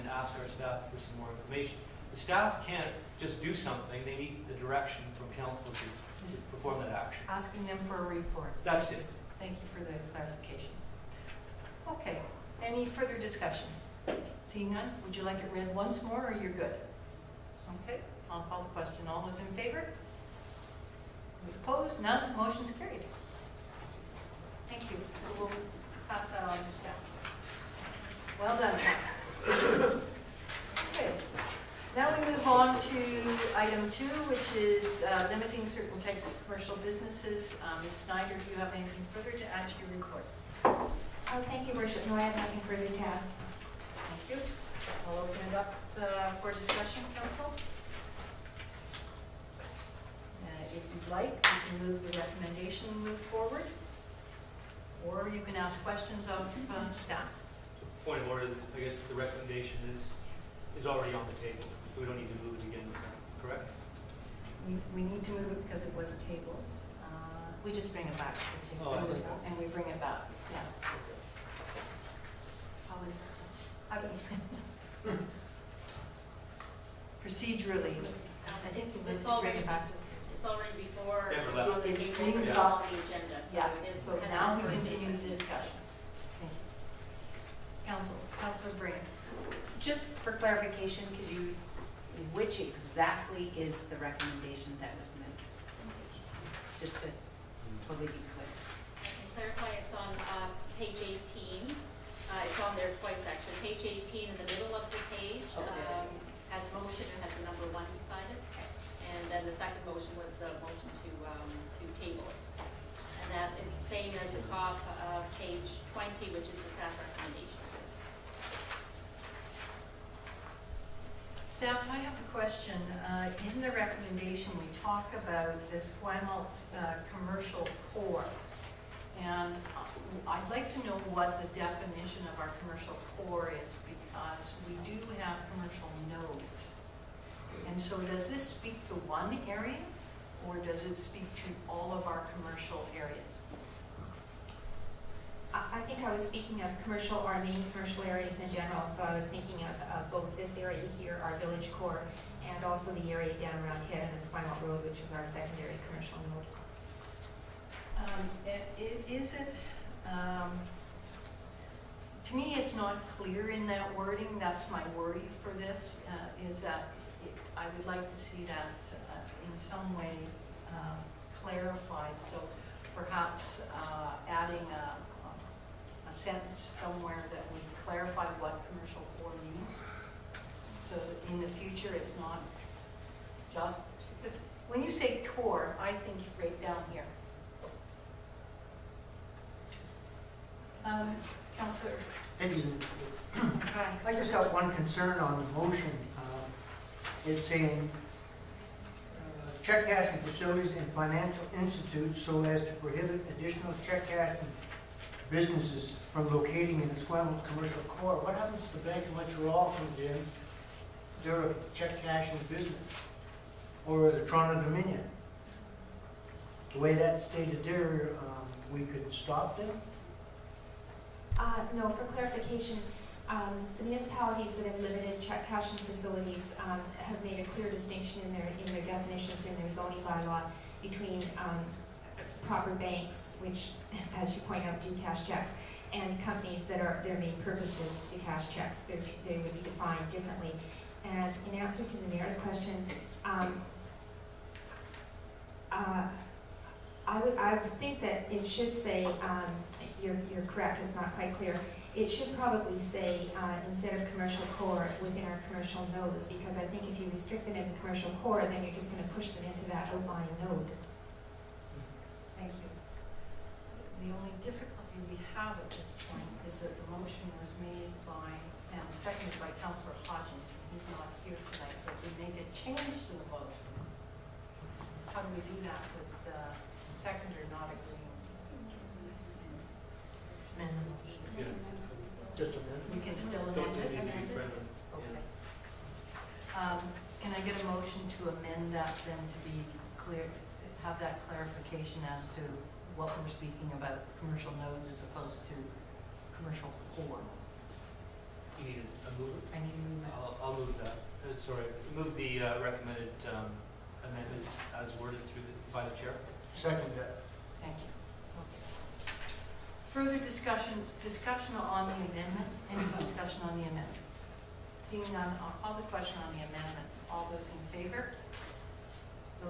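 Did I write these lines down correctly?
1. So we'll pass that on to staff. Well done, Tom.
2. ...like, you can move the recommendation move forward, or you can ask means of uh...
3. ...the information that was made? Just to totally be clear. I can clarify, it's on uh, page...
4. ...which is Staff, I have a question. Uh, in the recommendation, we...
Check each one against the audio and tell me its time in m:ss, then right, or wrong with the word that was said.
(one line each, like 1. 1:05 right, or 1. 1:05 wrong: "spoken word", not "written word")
1. 0:25 right
2. 0:51 wrong: "questions", not "means"
3. 1:33 wrong: "recommendation", not "information"
4. 1:56 right.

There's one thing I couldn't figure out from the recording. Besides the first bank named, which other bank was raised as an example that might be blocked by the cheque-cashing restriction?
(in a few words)
Toronto Dominion.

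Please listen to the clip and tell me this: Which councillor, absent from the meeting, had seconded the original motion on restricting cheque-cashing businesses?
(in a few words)
Councillor Hodgins.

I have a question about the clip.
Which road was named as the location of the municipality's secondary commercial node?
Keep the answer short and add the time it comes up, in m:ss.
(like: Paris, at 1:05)
Spinal Road, at 2:34.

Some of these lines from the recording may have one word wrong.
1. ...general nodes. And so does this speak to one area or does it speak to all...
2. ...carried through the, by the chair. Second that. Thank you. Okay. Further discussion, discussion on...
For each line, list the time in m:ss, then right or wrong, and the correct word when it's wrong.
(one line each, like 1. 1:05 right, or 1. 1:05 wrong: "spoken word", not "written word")
1. 2:15 wrong: "commercial", not "general"
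2. 5:05 wrong: "worded", not "carried".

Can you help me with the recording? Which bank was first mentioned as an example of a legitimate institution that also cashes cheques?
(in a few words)
Bank of Montreal.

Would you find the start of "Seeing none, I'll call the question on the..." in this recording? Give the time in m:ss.
5:14.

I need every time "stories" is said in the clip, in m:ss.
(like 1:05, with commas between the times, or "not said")
not said.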